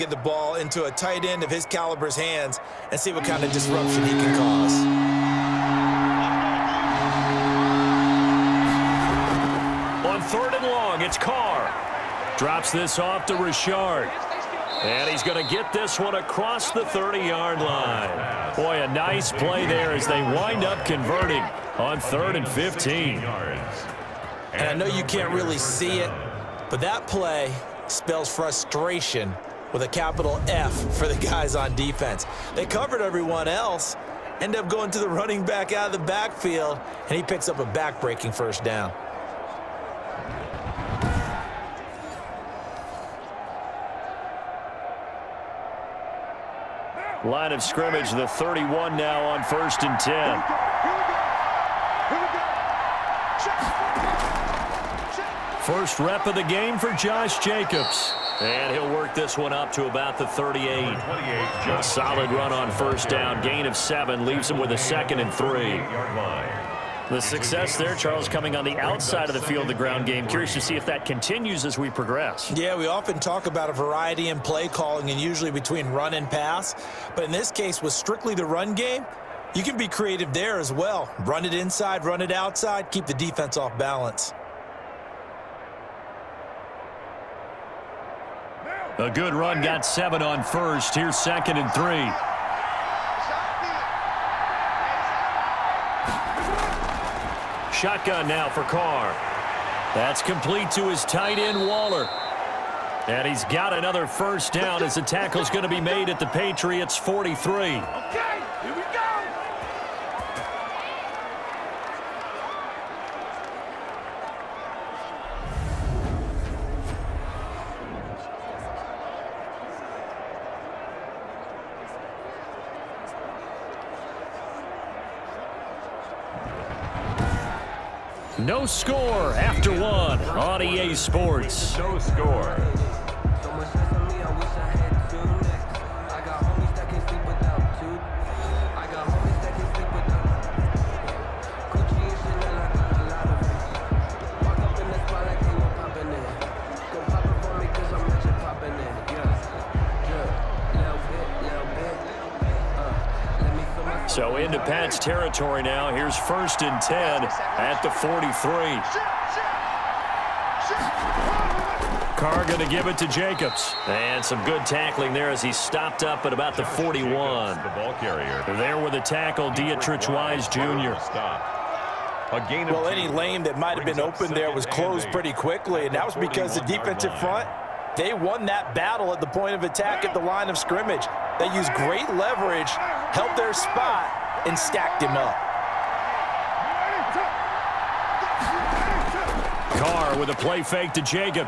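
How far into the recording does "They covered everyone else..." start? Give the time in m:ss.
0:32.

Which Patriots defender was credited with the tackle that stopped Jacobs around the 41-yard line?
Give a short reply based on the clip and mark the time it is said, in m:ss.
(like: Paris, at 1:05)
Deatrich Wise Jr., at 2:49.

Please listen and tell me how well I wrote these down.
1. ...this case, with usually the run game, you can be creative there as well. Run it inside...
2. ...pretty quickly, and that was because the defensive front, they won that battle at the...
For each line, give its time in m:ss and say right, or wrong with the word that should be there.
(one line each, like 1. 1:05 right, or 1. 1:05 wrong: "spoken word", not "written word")
1. 1:17 wrong: "strictly", not "usually"
2. 2:55 right.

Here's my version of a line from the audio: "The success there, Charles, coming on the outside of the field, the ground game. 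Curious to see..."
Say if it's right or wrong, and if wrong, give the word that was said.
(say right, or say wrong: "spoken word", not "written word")
right.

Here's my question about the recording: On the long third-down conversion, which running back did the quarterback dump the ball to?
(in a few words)
Richard.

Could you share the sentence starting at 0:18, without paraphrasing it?
Boy, a nice play there as they wind up converting on third and 15.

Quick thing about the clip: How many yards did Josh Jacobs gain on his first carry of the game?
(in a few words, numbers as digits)
7.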